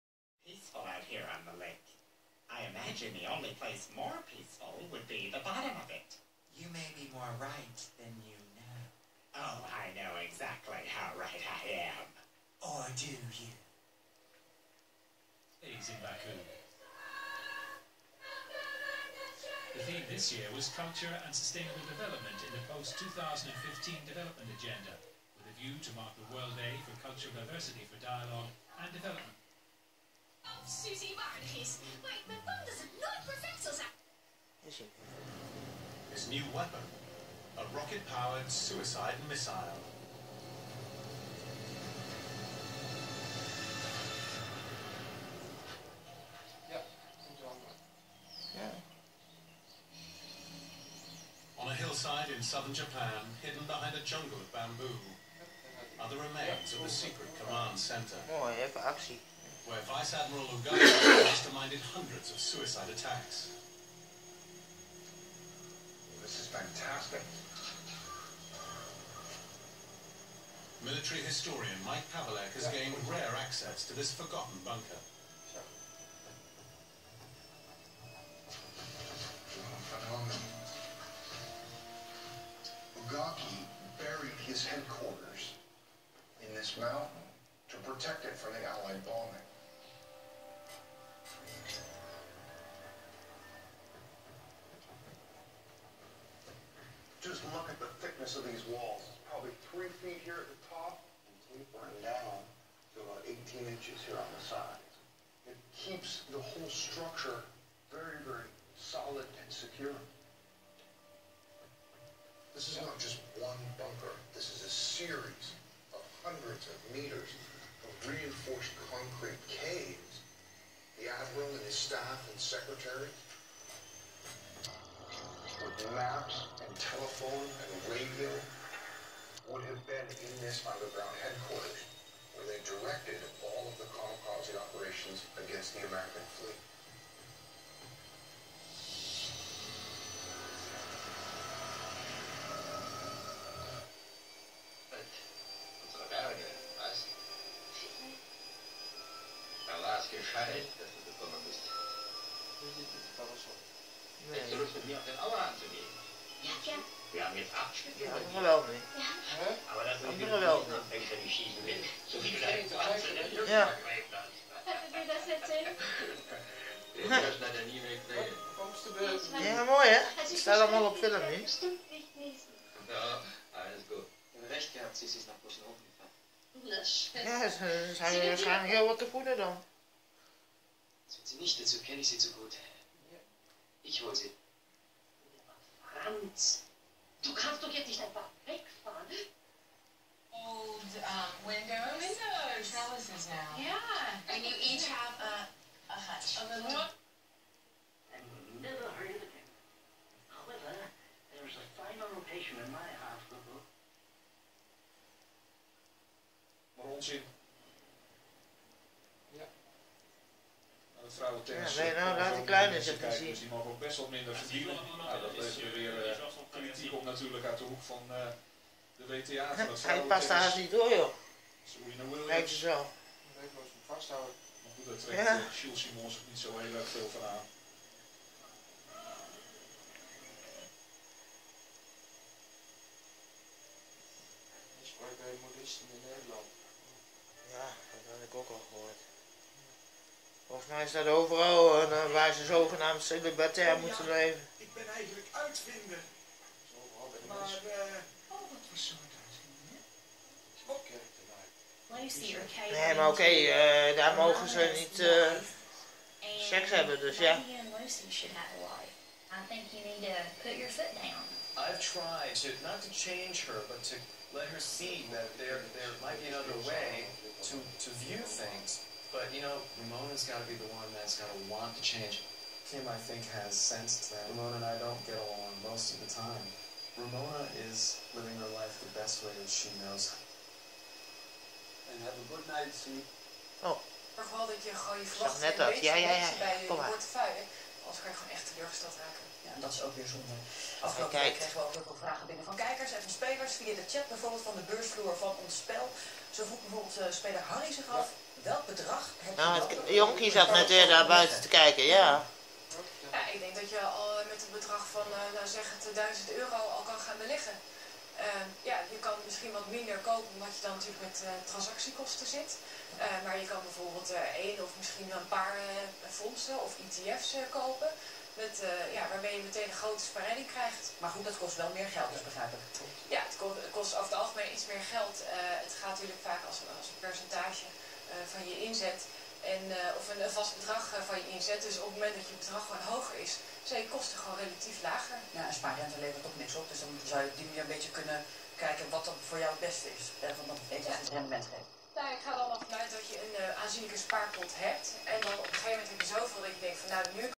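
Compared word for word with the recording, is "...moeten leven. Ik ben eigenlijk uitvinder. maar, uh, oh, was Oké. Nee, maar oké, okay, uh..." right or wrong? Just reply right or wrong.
right.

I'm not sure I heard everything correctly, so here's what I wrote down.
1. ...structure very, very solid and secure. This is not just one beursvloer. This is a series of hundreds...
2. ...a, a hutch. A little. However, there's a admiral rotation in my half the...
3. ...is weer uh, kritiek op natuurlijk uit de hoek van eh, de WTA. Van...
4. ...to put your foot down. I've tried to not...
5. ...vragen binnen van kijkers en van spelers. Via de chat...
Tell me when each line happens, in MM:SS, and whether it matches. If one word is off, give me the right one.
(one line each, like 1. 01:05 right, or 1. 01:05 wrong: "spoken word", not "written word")
1. 01:46 wrong: "bunker", not "beursvloer"
2. 03:15 wrong: "final", not "admiral"
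3. 03:35 right
4. 04:20 right
5. 04:52 right.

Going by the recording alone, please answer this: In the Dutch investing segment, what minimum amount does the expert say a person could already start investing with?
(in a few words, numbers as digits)
1000 euro.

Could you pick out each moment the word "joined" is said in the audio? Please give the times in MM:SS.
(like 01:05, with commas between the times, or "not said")
not said.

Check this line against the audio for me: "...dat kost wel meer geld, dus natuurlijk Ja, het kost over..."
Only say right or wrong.
wrong.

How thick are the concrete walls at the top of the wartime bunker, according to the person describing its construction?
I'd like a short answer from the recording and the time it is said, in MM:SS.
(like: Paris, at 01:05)
3 feet, at 01:39.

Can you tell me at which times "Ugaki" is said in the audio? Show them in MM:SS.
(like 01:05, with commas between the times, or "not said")
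01:00, 01:23.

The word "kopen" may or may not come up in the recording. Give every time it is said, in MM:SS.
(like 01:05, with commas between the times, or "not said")
05:10, 05:17.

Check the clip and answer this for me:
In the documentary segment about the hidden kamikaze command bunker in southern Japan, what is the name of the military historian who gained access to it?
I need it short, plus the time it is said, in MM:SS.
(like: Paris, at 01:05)
Mike Pavelek, at 01:11.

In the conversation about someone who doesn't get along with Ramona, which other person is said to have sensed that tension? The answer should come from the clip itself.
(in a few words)
Kim.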